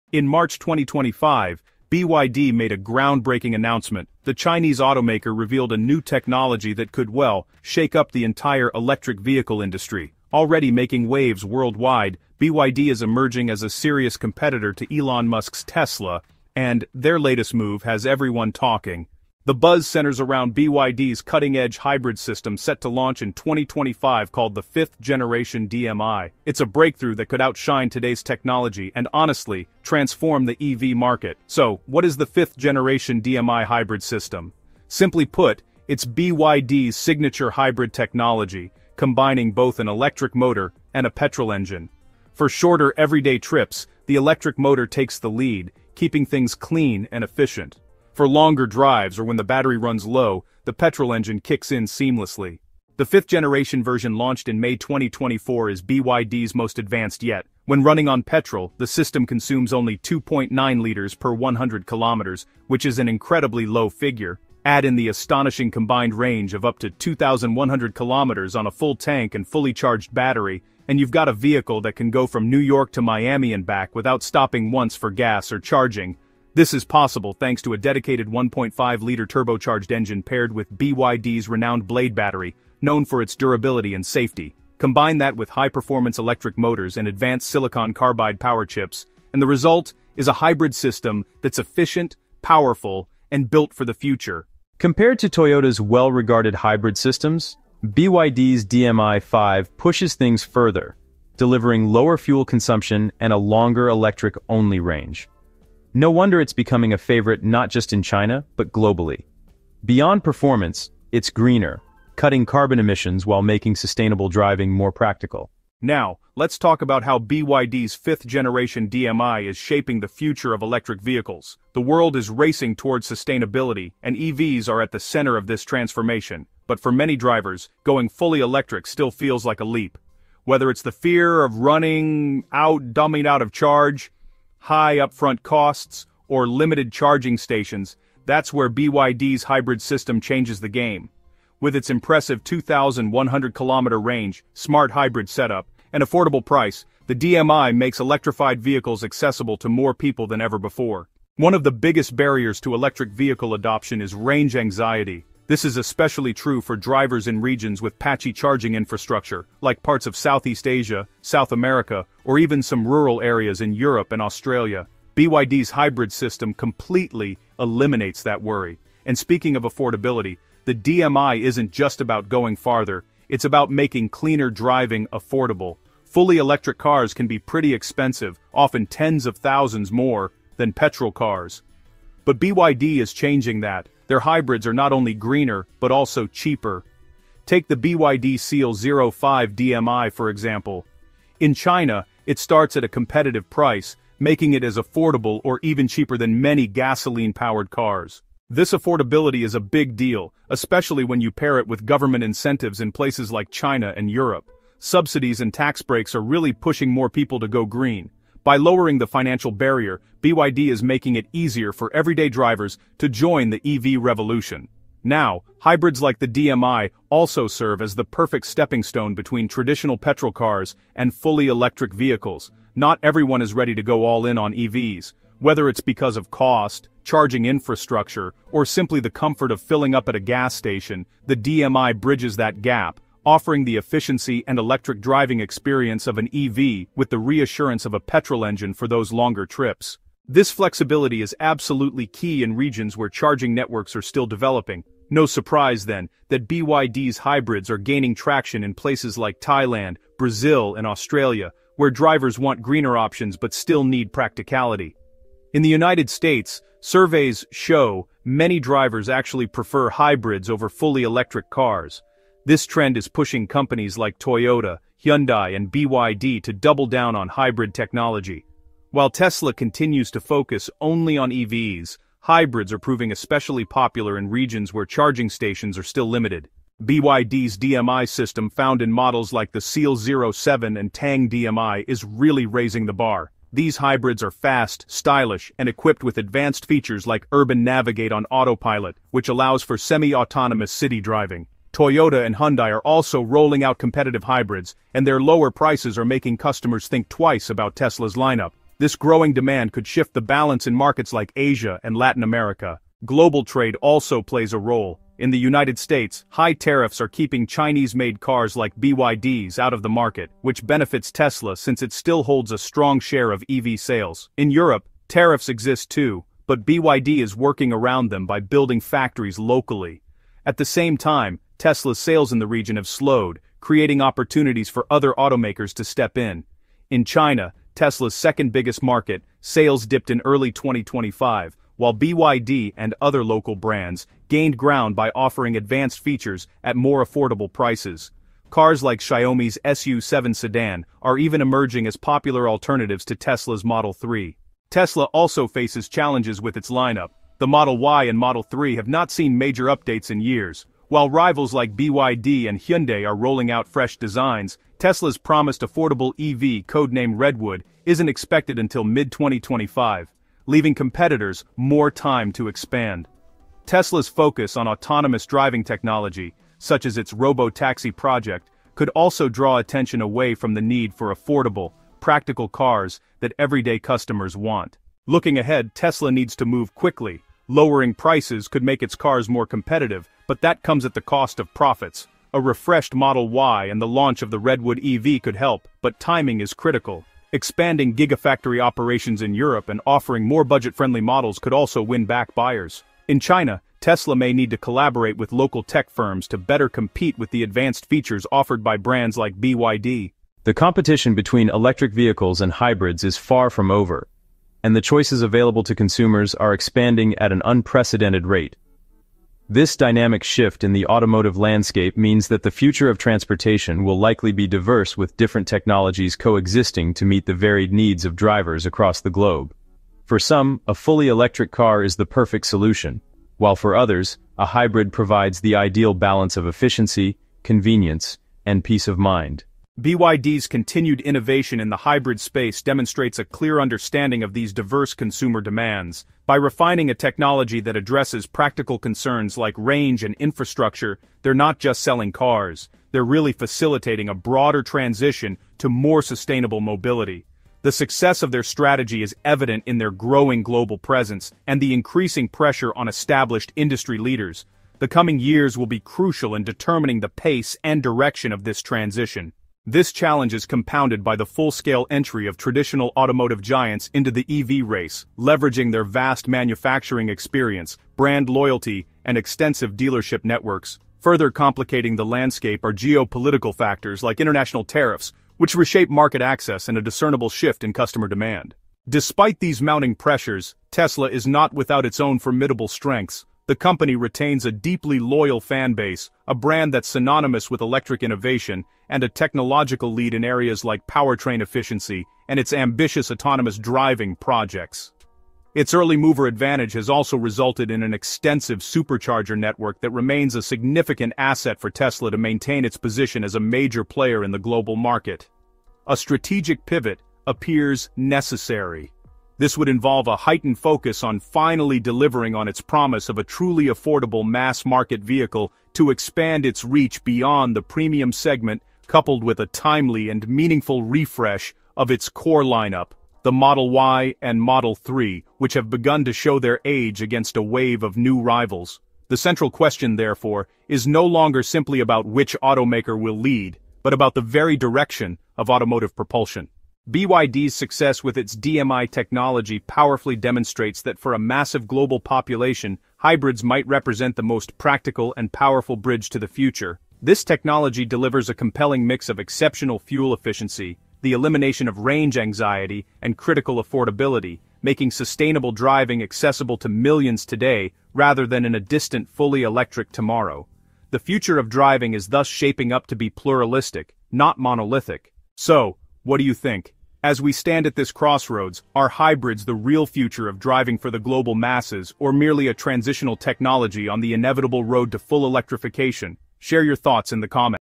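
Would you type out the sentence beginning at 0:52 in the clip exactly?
The fifth-generation version launched in May 2024 is BYD's most advanced yet.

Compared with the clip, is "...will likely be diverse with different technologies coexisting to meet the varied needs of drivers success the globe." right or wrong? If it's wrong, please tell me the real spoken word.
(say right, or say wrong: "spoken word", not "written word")
wrong: "across", not "success".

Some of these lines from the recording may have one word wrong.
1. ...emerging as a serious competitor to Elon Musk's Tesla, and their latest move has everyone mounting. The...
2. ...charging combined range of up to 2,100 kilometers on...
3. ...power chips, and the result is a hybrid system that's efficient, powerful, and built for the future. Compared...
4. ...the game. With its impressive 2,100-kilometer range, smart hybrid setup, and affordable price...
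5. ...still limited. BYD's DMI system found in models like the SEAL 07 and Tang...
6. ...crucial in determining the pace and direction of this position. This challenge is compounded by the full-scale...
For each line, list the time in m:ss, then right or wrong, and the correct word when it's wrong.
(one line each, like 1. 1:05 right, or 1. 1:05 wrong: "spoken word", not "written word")
1. 0:13 wrong: "talking", not "mounting"
2. 1:05 wrong: "astonishing", not "charging"
3. 1:28 right
4. 2:20 right
5. 4:35 right
6. 7:35 wrong: "transition", not "position".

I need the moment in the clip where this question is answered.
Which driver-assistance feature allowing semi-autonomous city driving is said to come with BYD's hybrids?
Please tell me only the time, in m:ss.
4:47.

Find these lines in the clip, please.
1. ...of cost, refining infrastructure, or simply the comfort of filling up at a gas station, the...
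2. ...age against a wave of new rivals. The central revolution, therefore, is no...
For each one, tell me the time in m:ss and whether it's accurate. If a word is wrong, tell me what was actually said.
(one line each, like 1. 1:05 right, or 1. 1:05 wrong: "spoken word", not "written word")
1. 3:46 wrong: "charging", not "refining"
2. 8:46 wrong: "question", not "revolution".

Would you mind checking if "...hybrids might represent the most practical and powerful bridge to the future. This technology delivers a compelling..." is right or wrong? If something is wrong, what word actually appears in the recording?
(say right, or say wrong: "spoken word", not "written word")
right.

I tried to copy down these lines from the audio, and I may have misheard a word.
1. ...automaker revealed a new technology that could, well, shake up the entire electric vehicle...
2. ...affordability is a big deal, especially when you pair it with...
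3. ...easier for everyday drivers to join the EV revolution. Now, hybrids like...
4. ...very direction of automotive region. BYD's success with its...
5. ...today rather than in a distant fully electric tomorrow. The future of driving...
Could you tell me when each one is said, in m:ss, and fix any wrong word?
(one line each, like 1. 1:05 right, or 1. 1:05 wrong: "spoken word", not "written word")
1. 0:04 right
2. 3:18 right
3. 3:31 right
4. 8:54 wrong: "propulsion", not "region"
5. 9:17 right.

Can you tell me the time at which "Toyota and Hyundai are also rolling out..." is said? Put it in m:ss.
4:51.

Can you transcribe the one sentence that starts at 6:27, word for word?
Expanding gigafactory operations in Europe and offering more budget-friendly models could also win back buyers.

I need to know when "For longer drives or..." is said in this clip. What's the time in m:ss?
0:48.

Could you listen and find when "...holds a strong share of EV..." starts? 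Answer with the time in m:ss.
5:12.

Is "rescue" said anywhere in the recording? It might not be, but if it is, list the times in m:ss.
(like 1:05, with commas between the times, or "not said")
not said.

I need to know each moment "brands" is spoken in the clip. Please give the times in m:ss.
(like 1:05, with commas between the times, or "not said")
5:33, 6:38, 7:47, 8:06.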